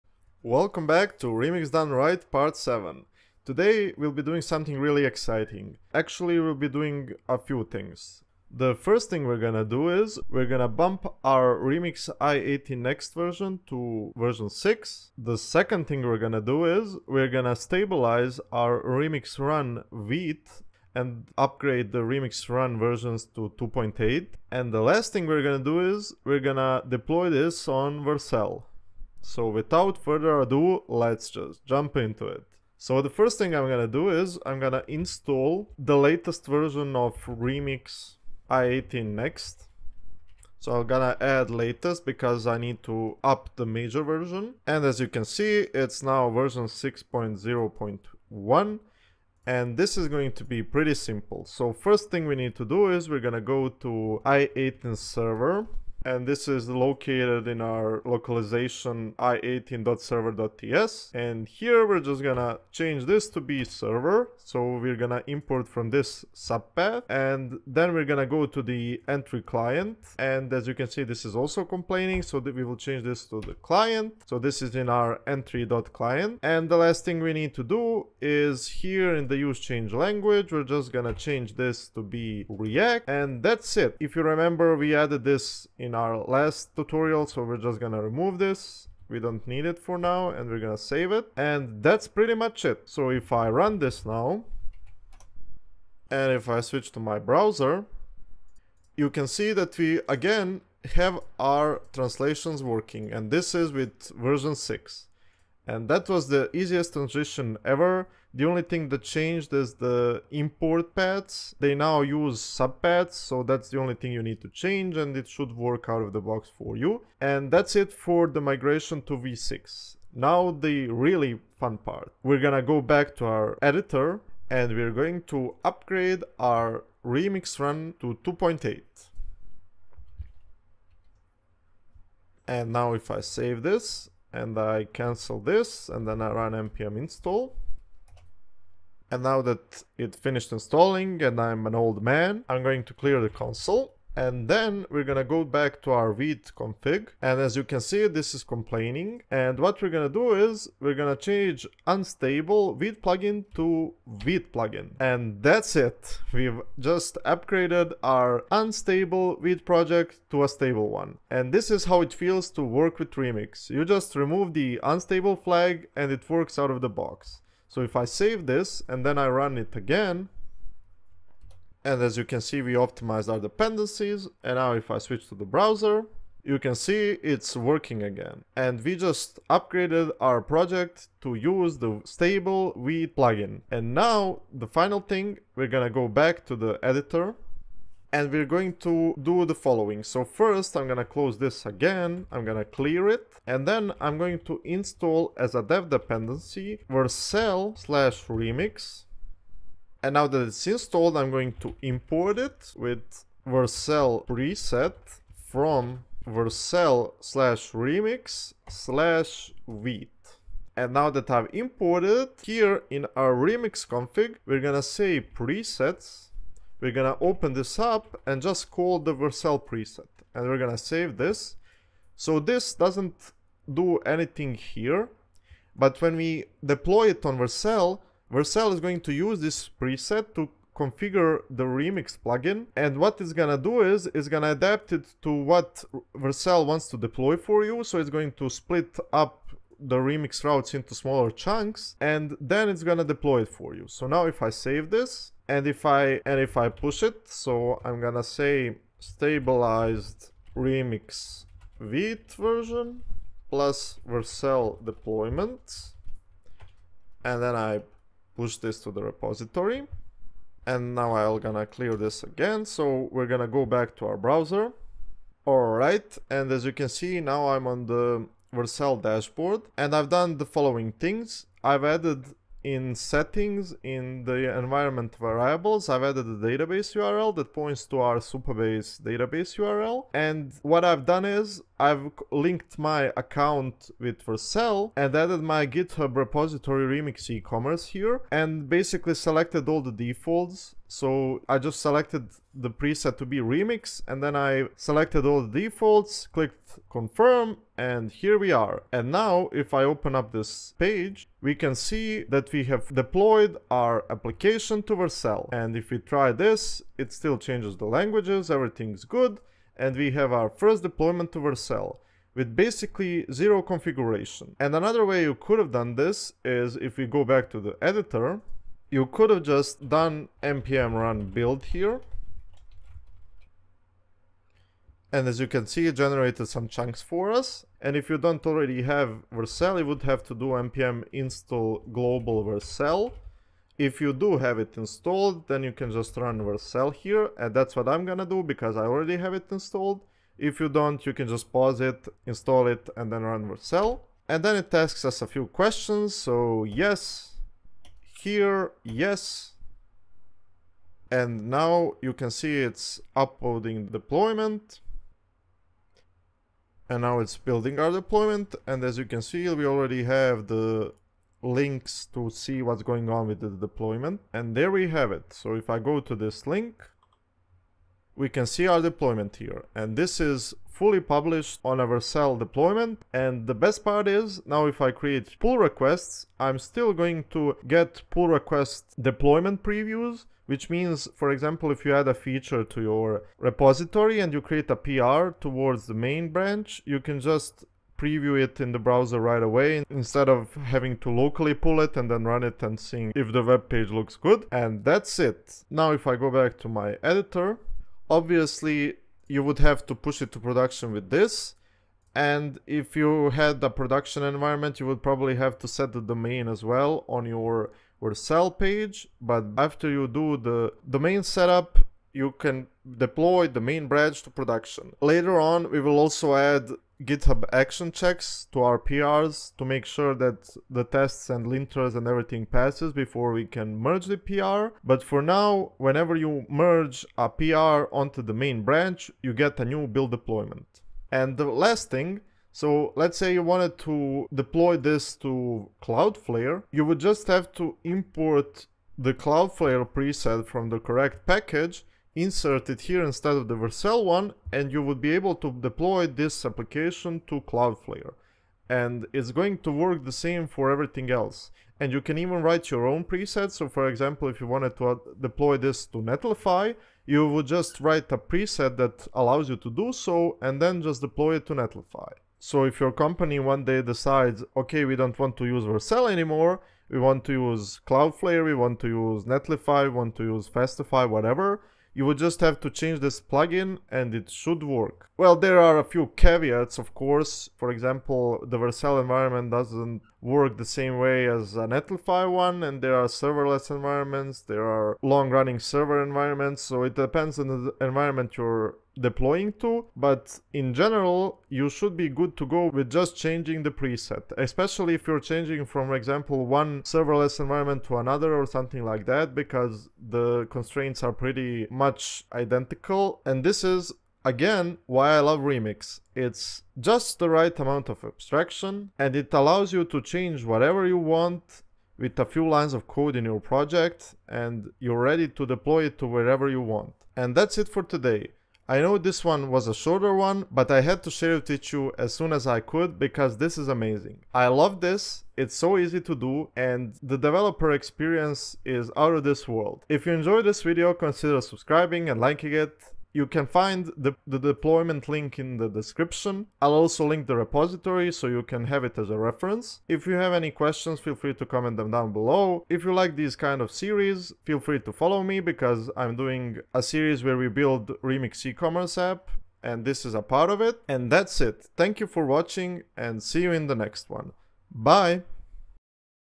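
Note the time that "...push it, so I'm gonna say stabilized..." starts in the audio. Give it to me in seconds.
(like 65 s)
246 s.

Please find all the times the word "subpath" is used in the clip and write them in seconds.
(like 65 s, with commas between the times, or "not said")
66 s, 112 s.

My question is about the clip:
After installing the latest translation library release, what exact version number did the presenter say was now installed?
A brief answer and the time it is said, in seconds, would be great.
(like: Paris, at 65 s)
6.0.1, at 46 s.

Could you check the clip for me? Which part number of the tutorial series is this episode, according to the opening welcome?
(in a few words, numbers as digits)
7.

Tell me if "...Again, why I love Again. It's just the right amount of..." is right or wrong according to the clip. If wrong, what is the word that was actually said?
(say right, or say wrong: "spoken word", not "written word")
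wrong: "Remix", not "Again".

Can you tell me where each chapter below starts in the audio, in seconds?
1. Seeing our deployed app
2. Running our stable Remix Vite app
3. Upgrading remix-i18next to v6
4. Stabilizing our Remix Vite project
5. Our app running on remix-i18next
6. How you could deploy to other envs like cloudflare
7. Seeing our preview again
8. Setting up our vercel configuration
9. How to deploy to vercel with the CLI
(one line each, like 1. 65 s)
1. 300 s
2. 176 s
3. 32 s
4. 120 s
5. 98 s
6. 431 s
7. 366 s
8. 188 s
9. 318 s.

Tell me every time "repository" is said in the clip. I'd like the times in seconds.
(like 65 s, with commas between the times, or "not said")
259 s, 286 s, 383 s, 537 s.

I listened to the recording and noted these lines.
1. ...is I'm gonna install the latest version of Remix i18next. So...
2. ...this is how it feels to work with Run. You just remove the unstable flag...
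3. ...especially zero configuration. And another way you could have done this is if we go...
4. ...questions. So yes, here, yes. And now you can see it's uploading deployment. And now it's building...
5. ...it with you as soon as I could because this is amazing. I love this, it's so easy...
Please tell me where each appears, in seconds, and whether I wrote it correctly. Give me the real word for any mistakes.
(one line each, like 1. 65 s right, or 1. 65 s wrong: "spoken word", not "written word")
1. 34 s right
2. 161 s wrong: "Remix", not "Run"
3. 312 s wrong: "basically", not "especially"
4. 345 s right
5. 521 s right.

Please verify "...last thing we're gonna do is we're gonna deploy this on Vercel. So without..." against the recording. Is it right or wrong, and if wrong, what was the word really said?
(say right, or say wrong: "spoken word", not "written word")
right.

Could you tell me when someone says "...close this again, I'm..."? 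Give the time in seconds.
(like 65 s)
191 s.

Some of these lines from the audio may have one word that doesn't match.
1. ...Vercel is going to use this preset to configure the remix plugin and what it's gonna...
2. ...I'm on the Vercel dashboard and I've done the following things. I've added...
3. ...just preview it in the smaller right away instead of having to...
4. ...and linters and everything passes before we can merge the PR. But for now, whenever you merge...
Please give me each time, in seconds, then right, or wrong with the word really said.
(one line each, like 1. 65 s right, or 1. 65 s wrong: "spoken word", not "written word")
1. 228 s right
2. 267 s right
3. 387 s wrong: "browser", not "smaller"
4. 421 s right.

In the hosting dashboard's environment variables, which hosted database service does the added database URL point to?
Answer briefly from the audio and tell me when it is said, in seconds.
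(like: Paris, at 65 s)
Supabase, at 278 s.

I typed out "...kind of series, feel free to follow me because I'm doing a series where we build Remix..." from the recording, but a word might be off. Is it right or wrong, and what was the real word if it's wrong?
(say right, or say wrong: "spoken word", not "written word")
right.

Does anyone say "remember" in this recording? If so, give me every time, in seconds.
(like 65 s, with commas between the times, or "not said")
84 s.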